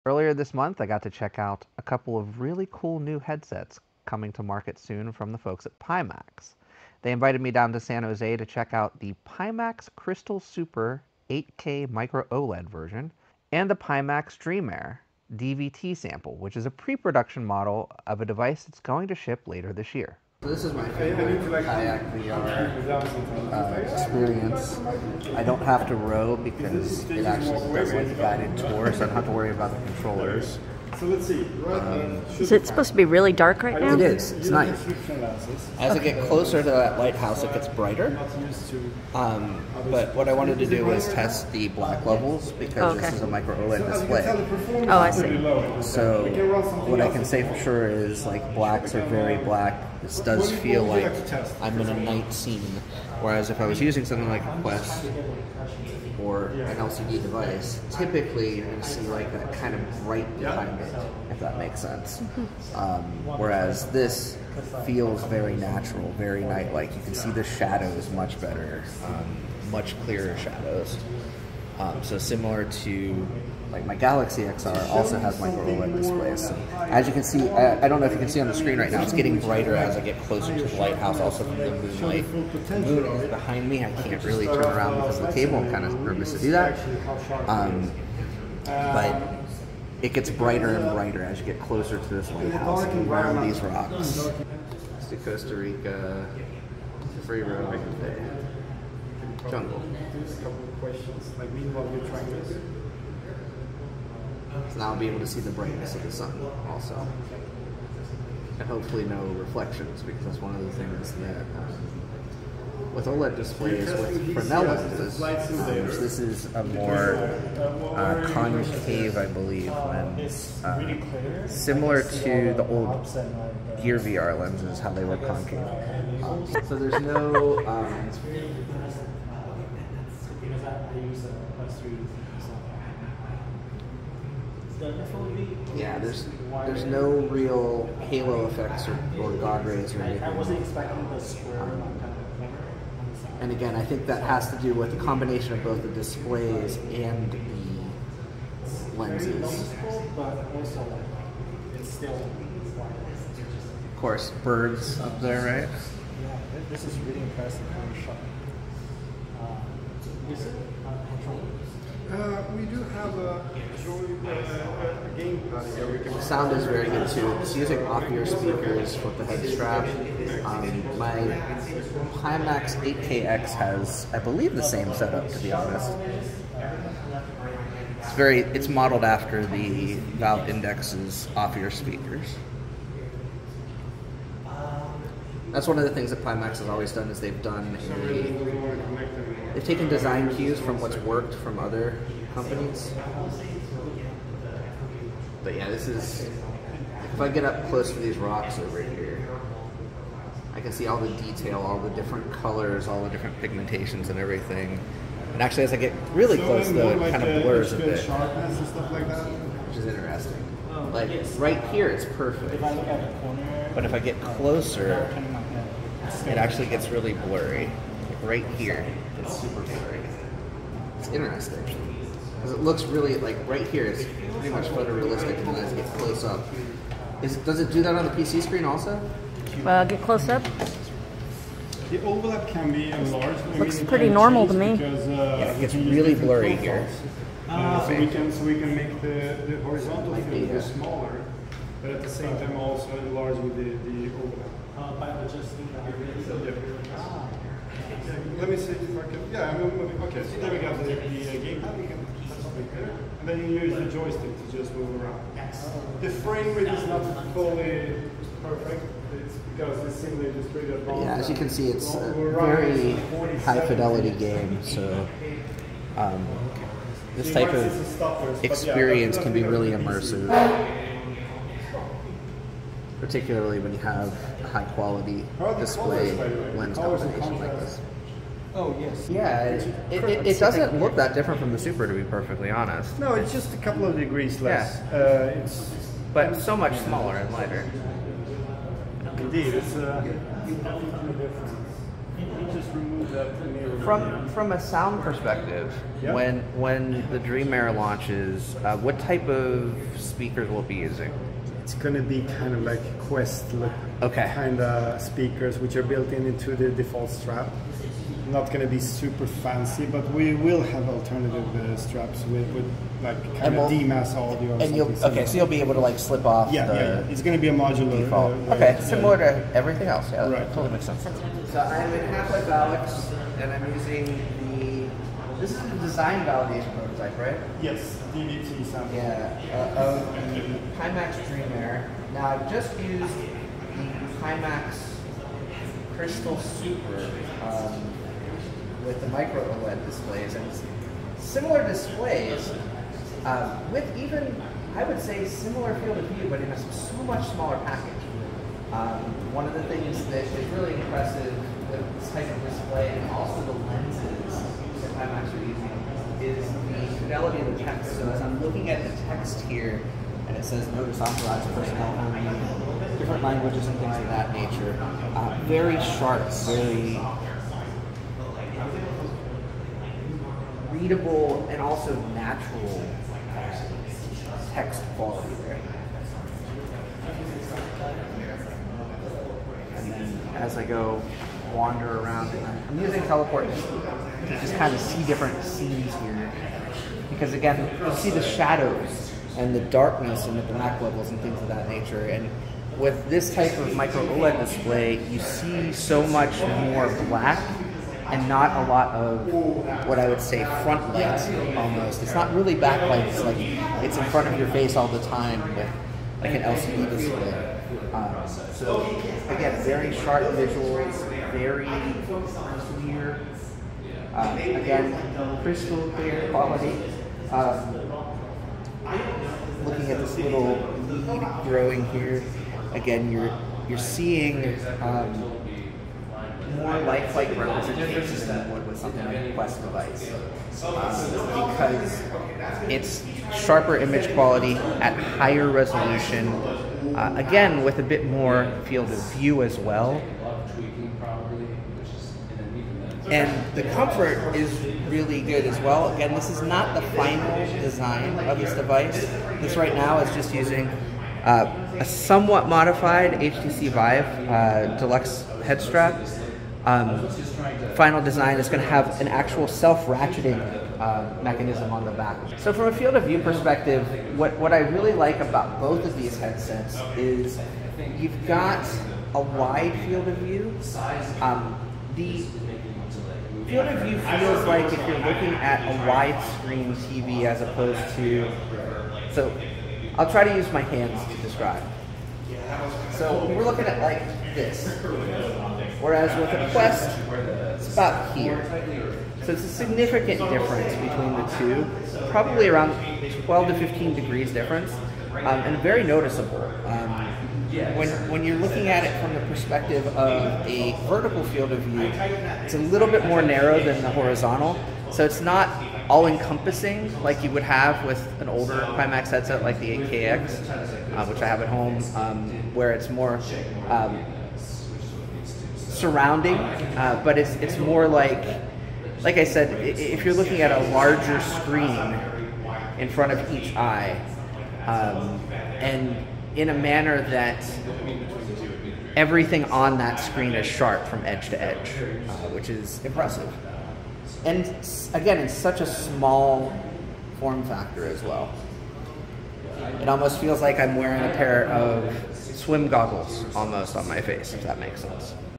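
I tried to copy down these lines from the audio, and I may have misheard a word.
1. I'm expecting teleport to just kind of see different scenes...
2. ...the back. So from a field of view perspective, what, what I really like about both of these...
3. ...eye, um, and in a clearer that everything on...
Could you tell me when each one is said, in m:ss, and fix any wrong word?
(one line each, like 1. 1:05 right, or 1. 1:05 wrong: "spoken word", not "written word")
1. 6:22 wrong: "using", not "expecting"
2. 7:41 right
3. 8:43 wrong: "manner", not "clearer".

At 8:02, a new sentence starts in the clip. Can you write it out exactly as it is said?
So we're looking at like this, whereas with a Quest, it's about here.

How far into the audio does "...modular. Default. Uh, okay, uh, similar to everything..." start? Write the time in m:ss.
5:17.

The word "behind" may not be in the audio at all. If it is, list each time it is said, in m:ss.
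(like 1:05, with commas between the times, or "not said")
1:00, 1:23.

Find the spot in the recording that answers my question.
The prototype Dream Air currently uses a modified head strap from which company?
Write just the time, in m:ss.
7:33.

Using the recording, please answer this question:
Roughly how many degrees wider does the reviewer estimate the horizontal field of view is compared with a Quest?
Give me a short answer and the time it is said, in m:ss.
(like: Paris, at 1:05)
12 to 15 degrees, at 8:13.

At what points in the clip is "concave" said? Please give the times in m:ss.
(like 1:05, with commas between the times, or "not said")
1:58, 2:05.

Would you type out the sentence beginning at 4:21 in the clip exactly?
Yeah, as you can see, it's a very high fidelity game.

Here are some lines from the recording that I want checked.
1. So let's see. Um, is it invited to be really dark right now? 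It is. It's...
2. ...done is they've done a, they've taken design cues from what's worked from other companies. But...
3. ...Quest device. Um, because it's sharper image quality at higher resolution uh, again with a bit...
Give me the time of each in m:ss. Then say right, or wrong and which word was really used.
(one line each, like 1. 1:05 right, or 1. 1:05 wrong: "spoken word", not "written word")
1. 0:30 wrong: "supposed", not "invited"
2. 3:06 right
3. 7:09 right.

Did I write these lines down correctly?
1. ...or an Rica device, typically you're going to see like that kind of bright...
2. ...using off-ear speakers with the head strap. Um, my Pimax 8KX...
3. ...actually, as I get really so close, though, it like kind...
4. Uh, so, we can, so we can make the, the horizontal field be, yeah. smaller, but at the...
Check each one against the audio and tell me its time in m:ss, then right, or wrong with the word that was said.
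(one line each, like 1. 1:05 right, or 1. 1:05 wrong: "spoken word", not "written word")
1. 0:56 wrong: "LCD", not "Rica"
2. 2:47 right
3. 3:25 right
4. 3:57 right.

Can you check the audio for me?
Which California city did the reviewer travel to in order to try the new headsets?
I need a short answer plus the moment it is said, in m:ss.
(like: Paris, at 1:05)
San Jose, at 0:07.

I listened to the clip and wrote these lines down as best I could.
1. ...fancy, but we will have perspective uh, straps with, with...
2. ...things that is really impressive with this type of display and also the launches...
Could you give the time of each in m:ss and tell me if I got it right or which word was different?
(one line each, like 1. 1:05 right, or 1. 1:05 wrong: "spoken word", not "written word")
1. 5:09 wrong: "alternative", not "perspective"
2. 5:49 wrong: "lenses", not "launches".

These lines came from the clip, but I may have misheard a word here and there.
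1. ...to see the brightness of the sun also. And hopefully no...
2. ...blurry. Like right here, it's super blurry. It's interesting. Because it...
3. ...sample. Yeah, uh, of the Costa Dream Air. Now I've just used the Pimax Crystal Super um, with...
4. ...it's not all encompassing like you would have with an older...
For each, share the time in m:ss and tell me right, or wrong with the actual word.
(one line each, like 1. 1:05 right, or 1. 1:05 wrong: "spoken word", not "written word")
1. 1:45 right
2. 3:37 right
3. 5:28 wrong: "Pimax", not "Costa"
4. 8:25 right.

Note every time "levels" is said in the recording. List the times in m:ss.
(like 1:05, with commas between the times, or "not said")
0:42, 6:30.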